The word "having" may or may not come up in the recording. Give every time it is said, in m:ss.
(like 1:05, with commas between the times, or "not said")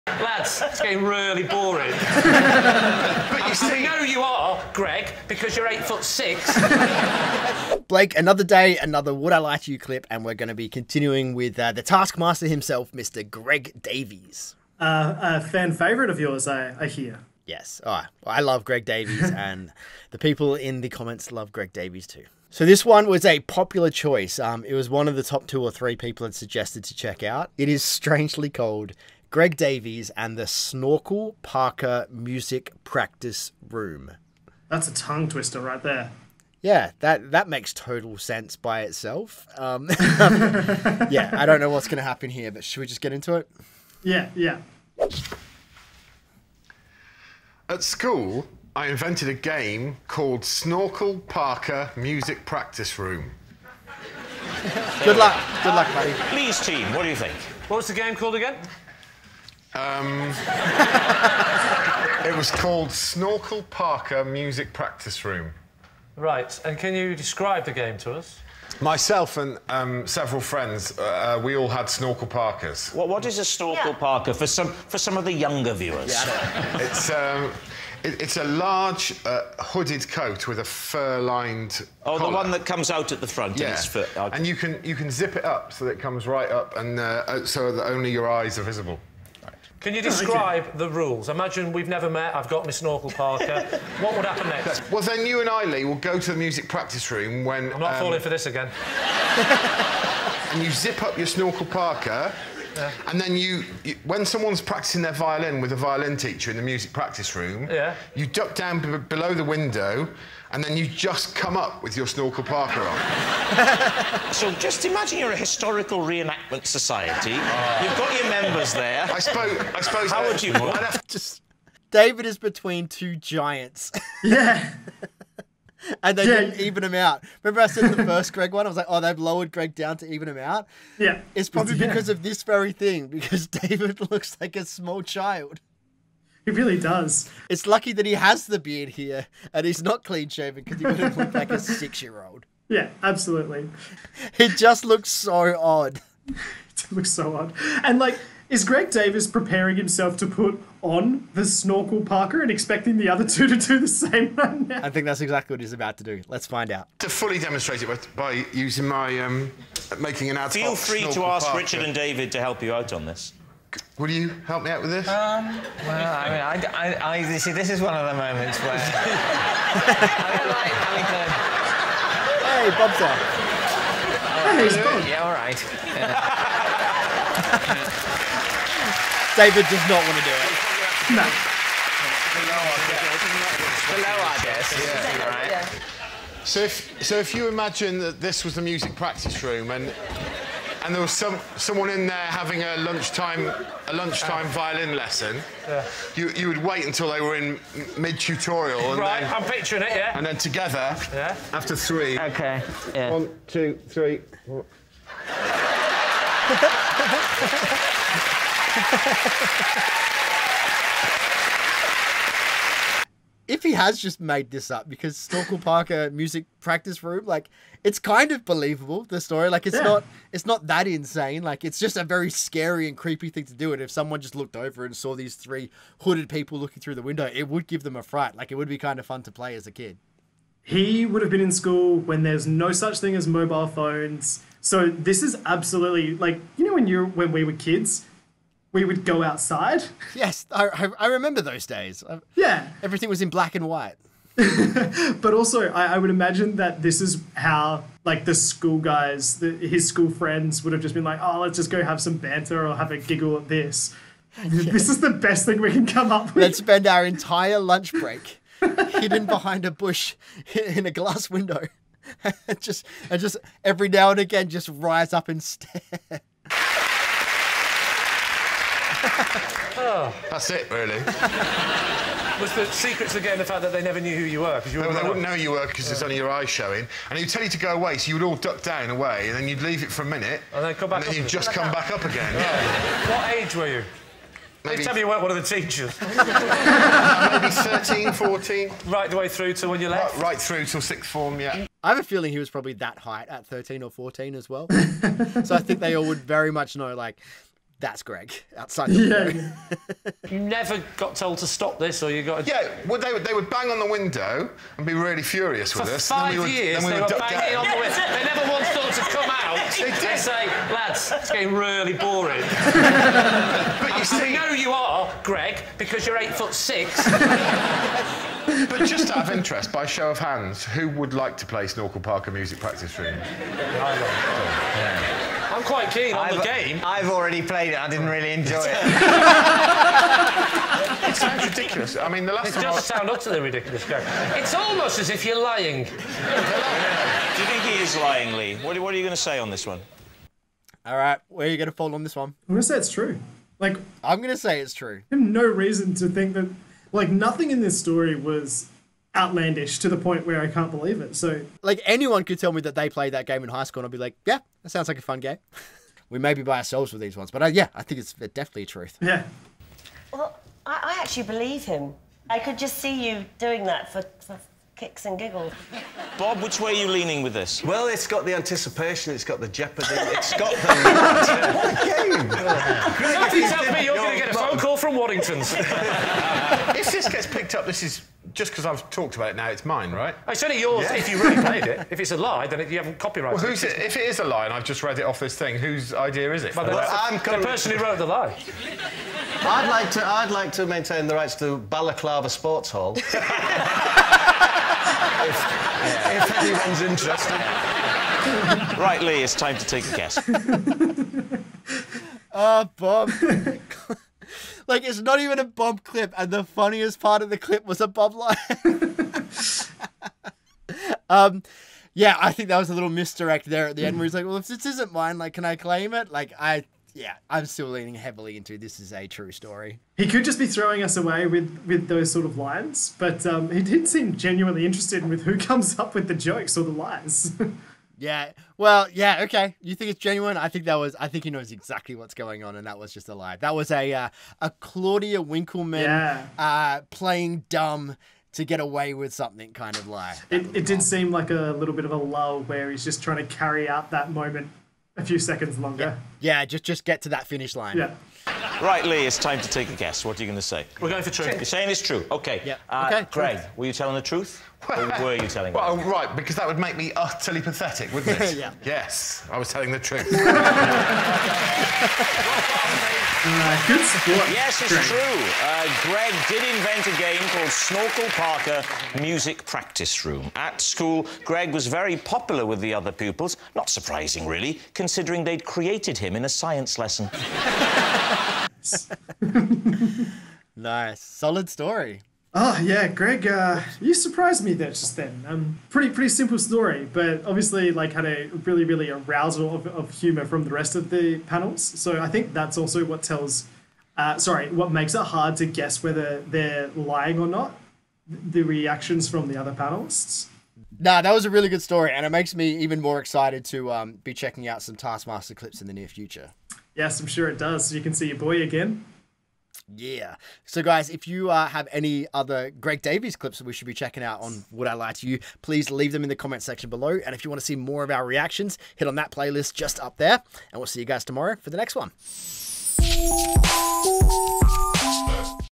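2:50, 3:12.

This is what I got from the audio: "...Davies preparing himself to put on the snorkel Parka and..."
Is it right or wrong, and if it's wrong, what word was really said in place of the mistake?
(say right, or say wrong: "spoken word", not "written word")
right.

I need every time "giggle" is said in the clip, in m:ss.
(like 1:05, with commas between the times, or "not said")
4:12, 6:05.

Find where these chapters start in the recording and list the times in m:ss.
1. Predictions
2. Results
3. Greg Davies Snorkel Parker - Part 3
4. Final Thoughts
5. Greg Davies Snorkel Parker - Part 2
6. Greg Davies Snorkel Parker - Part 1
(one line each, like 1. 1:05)
1. 5:40
2. 7:28
3. 4:27
4. 7:58
5. 2:37
6. 0:45.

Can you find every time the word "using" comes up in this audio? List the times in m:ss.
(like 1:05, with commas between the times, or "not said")
2:38.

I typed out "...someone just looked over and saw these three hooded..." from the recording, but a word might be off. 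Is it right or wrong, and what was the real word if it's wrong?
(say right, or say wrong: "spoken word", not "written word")
right.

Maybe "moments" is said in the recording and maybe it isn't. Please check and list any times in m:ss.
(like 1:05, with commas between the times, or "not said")
2:48, 7:24.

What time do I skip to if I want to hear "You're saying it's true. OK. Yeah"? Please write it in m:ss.
7:31.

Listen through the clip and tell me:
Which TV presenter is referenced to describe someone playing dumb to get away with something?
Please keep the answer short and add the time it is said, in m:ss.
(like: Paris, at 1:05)
Claudia Winkleman, at 7:14.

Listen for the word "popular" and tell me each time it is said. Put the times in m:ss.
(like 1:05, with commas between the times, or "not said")
0:23, 7:51.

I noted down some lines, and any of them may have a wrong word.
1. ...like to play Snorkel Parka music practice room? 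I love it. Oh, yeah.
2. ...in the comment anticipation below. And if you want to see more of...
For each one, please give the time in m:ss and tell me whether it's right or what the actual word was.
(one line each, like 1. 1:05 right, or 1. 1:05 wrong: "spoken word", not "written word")
1. 5:21 right
2. 8:36 wrong: "section", not "anticipation".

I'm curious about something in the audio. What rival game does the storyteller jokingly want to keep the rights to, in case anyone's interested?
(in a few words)
Balaclava Sports Hall.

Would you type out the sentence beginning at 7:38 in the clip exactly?
Yes, I was telling the truth.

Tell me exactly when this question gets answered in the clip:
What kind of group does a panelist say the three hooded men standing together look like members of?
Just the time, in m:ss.
1:55.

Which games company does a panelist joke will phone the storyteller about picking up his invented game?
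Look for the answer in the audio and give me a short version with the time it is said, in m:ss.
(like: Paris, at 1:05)
Waddington's, at 6:14.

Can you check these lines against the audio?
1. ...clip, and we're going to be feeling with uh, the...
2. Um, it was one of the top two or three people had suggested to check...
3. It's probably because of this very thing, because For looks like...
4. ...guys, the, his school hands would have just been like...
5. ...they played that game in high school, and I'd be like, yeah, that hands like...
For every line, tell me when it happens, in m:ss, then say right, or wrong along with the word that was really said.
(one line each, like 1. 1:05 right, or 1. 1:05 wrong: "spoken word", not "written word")
1. 0:09 wrong: "continuing", not "feeling"
2. 0:24 right
3. 2:11 wrong: "David", not "For"
4. 4:08 wrong: "friends", not "hands"
5. 5:52 wrong: "sounds", not "hands".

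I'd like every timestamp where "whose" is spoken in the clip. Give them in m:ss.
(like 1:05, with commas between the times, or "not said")
6:25.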